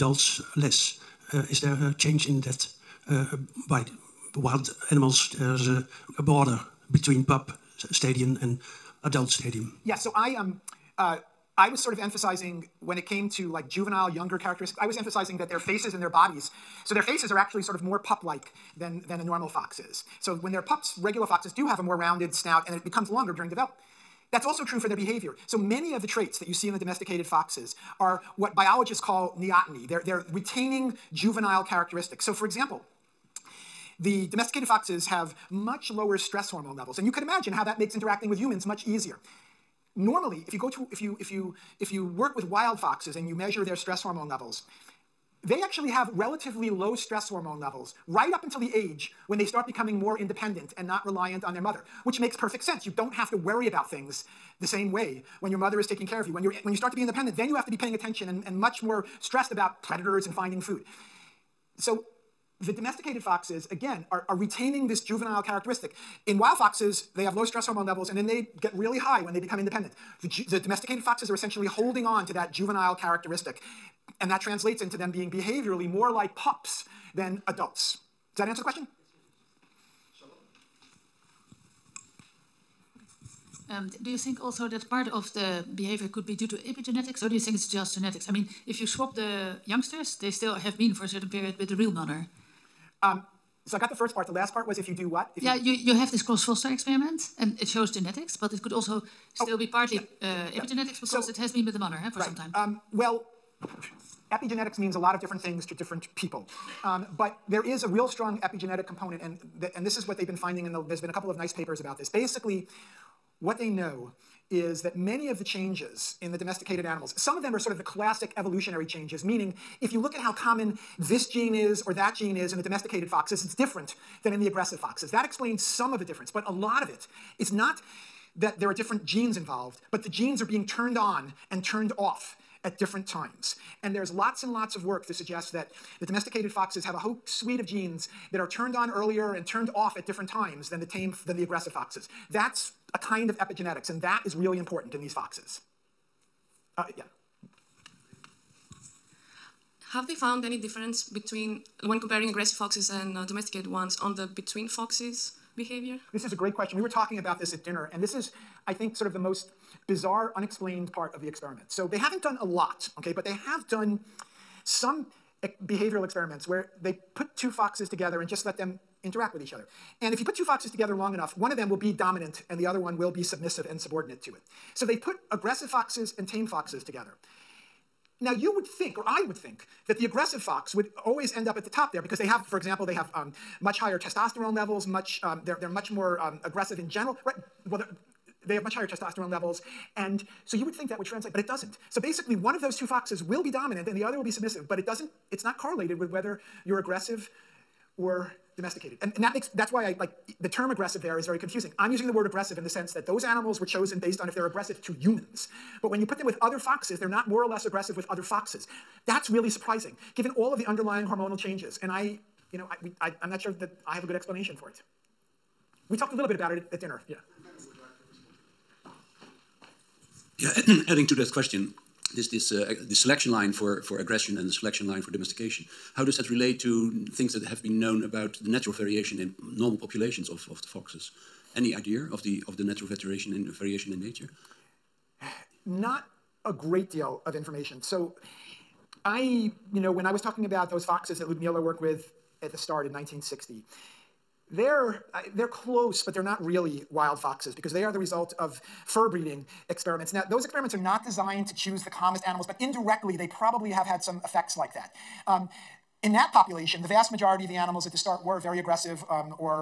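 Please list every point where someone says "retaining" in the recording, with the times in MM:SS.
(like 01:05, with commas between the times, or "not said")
00:30, 01:04.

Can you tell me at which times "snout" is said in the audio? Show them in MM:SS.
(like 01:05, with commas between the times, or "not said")
00:22.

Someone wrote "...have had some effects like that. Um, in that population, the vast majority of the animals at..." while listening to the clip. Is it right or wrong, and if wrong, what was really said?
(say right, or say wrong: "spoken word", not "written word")
right.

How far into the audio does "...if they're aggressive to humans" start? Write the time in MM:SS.
03:24.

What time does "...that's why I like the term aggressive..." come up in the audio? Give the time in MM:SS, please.
03:19.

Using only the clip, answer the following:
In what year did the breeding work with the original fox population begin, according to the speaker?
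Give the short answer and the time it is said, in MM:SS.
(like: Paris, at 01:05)
1960, at 04:02.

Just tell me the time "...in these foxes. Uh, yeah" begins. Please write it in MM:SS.
02:24.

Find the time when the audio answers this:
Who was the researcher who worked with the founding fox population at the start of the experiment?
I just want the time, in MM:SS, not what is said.
04:01.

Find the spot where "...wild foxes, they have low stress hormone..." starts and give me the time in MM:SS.
01:06.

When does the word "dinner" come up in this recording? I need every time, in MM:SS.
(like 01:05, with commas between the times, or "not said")
02:37, 03:36.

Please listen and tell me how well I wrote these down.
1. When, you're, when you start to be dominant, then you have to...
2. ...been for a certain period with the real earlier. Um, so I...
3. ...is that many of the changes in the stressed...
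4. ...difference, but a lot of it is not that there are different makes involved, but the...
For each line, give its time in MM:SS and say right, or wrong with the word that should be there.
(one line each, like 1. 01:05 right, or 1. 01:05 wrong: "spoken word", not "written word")
1. 00:56 wrong: "independent", not "dominant"
2. 01:30 wrong: "mother", not "earlier"
3. 01:54 wrong: "domesticated", not "stressed"
4. 02:06 wrong: "genes", not "makes".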